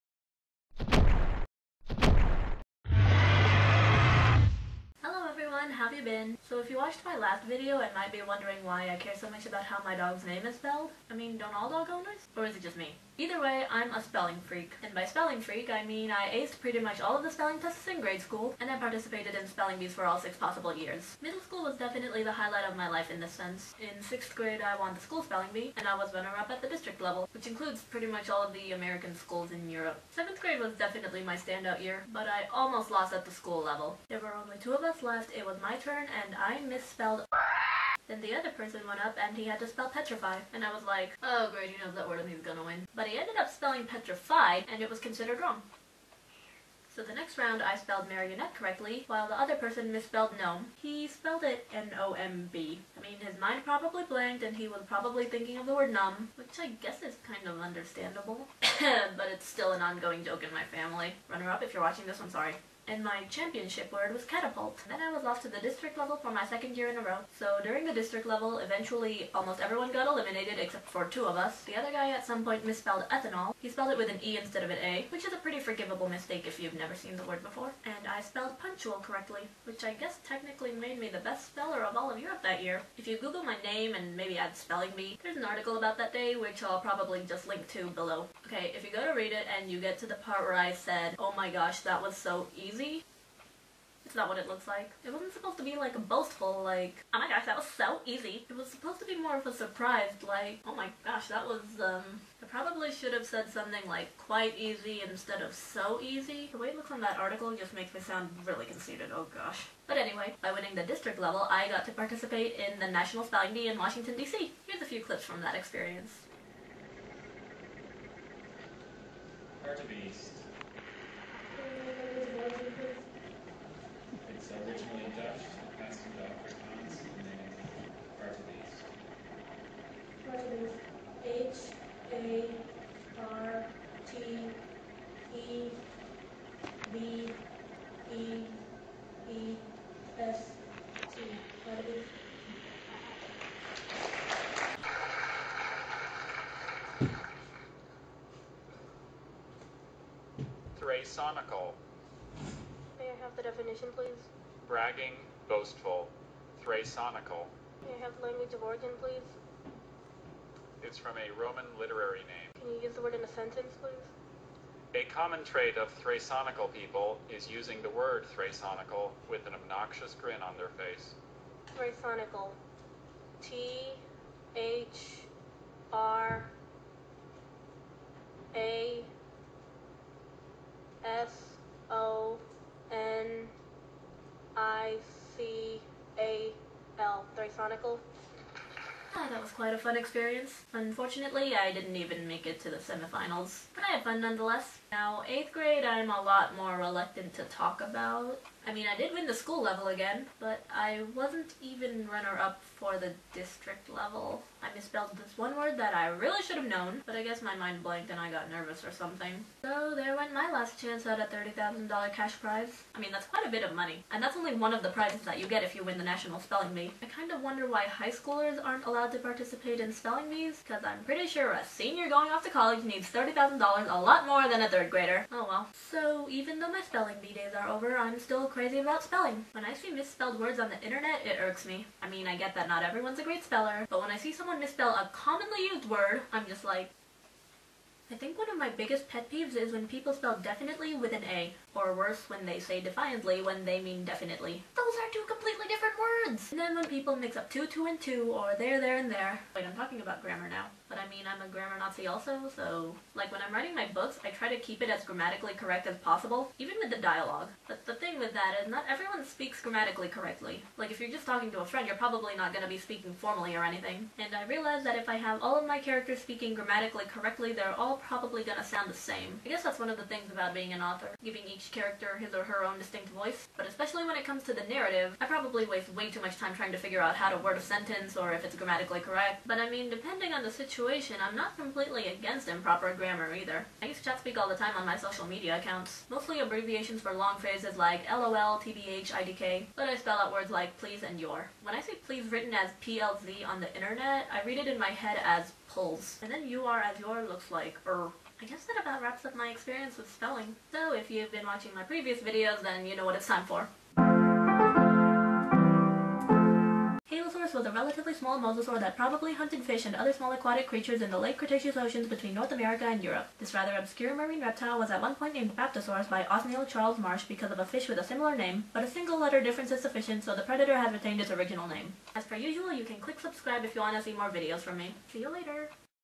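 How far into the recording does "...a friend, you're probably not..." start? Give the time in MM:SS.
04:21.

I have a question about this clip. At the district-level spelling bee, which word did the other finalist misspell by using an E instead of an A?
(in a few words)
ethanol.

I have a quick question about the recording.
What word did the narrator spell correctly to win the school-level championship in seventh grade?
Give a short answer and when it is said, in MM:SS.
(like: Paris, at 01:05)
catapult, at 01:04.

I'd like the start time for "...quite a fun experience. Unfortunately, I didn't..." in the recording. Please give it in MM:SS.
03:09.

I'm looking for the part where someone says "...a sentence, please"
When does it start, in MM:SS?
02:43.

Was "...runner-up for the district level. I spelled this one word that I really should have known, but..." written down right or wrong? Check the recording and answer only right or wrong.
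wrong.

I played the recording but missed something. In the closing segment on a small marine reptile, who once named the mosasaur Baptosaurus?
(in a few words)
Othniel Charles Marsh.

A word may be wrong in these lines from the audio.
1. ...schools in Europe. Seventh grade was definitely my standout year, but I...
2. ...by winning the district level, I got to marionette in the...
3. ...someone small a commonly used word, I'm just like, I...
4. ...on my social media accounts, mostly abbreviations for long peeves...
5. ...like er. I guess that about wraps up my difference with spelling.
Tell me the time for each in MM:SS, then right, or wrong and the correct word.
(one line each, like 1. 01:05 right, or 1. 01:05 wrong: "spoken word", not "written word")
1. 00:29 right
2. 01:50 wrong: "participate", not "marionette"
3. 03:54 wrong: "misspell", not "small"
4. 04:44 wrong: "phrases", not "peeves"
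5. 04:57 wrong: "experience", not "difference".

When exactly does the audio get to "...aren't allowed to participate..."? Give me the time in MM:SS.
03:38.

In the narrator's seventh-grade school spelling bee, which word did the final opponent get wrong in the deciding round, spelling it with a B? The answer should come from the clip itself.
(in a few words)
gnome.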